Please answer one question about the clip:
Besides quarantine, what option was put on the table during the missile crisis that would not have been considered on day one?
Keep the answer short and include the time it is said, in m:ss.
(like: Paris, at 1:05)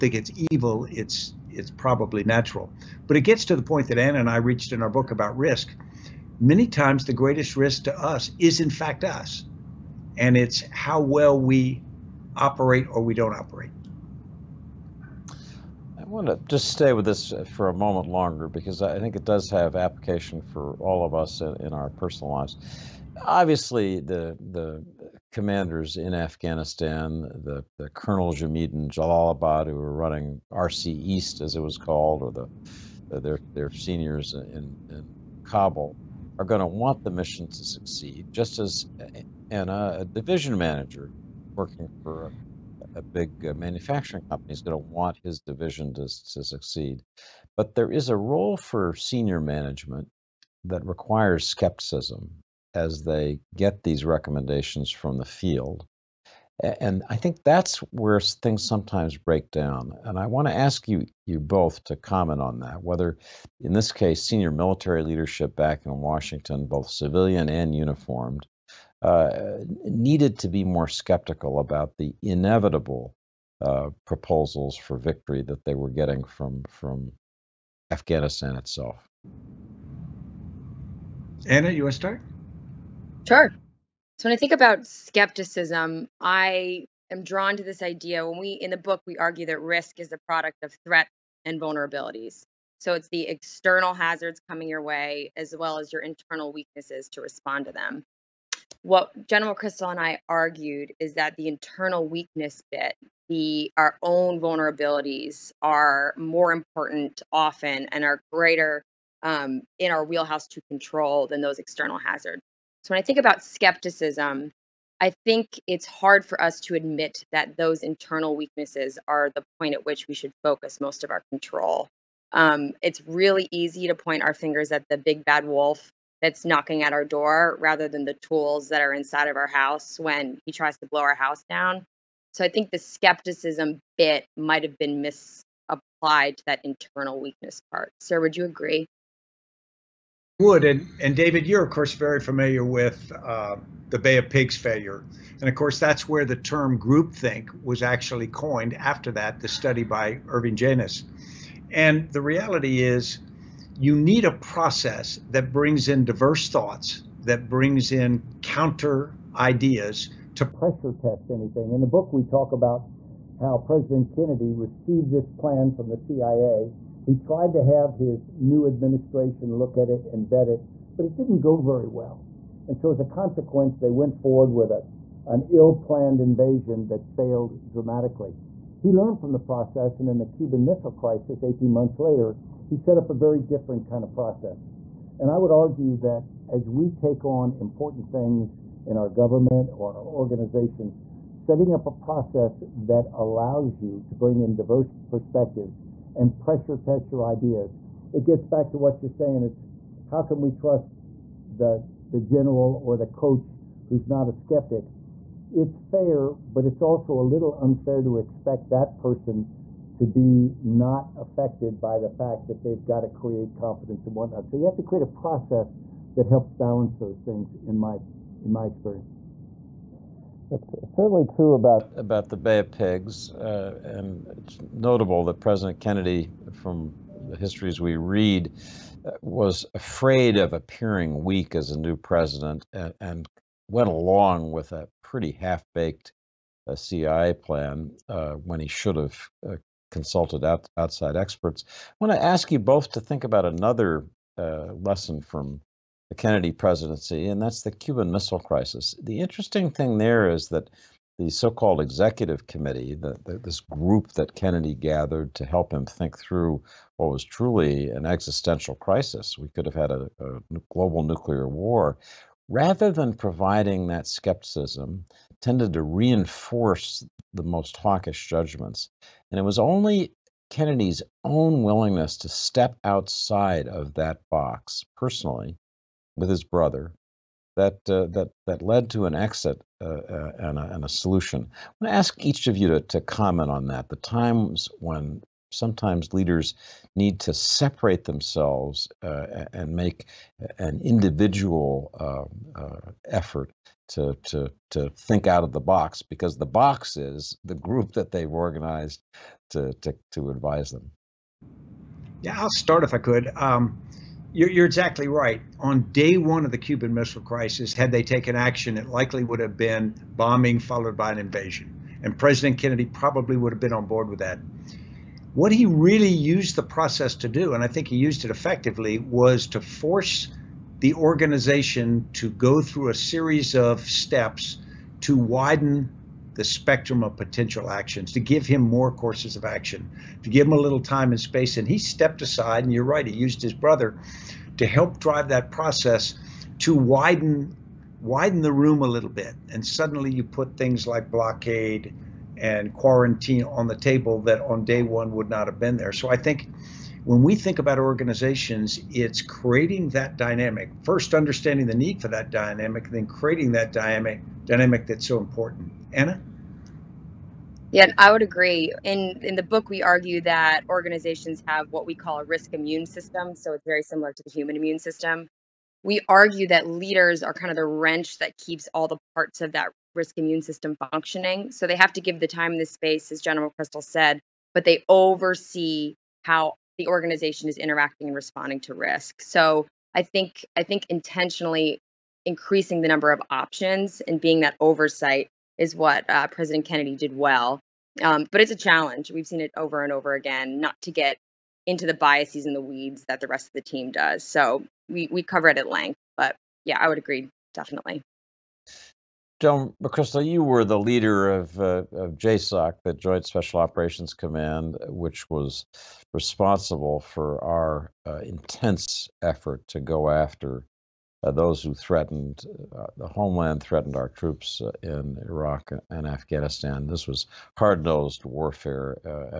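blockade, at 5:41.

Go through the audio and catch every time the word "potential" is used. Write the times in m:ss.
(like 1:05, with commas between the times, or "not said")
5:27.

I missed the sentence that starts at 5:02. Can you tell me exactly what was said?
Yeah, I'll start if I could.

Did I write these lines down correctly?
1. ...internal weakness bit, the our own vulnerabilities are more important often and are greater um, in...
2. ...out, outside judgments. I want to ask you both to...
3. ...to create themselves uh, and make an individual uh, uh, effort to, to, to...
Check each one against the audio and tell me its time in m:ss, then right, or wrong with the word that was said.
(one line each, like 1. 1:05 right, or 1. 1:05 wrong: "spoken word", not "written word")
1. 1:41 right
2. 4:00 wrong: "experts", not "judgments"
3. 4:47 wrong: "separate", not "create".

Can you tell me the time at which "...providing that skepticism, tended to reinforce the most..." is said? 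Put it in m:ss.
4:23.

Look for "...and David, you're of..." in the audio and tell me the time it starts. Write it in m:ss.
2:20.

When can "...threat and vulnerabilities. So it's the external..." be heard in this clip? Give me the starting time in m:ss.
1:30.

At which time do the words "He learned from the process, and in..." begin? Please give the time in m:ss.
2:58.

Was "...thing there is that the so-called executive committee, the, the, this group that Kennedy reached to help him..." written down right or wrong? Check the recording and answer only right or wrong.
wrong.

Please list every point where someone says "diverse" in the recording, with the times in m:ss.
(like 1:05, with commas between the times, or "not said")
2:36, 3:14.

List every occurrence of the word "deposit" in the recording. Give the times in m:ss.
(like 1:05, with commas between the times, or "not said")
not said.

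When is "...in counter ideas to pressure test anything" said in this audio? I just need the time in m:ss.
2:37.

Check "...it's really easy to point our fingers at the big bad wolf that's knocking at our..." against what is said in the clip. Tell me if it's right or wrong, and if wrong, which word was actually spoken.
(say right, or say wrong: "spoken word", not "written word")
right.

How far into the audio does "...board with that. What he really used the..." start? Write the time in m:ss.
5:13.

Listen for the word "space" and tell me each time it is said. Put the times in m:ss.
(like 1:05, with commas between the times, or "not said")
5:31, 6:12.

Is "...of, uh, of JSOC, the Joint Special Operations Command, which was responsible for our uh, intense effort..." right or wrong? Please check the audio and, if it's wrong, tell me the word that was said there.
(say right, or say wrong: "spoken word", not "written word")
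right.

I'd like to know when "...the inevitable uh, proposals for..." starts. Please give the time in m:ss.
1:11.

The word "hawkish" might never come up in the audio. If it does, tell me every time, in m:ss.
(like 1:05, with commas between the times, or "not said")
4:27.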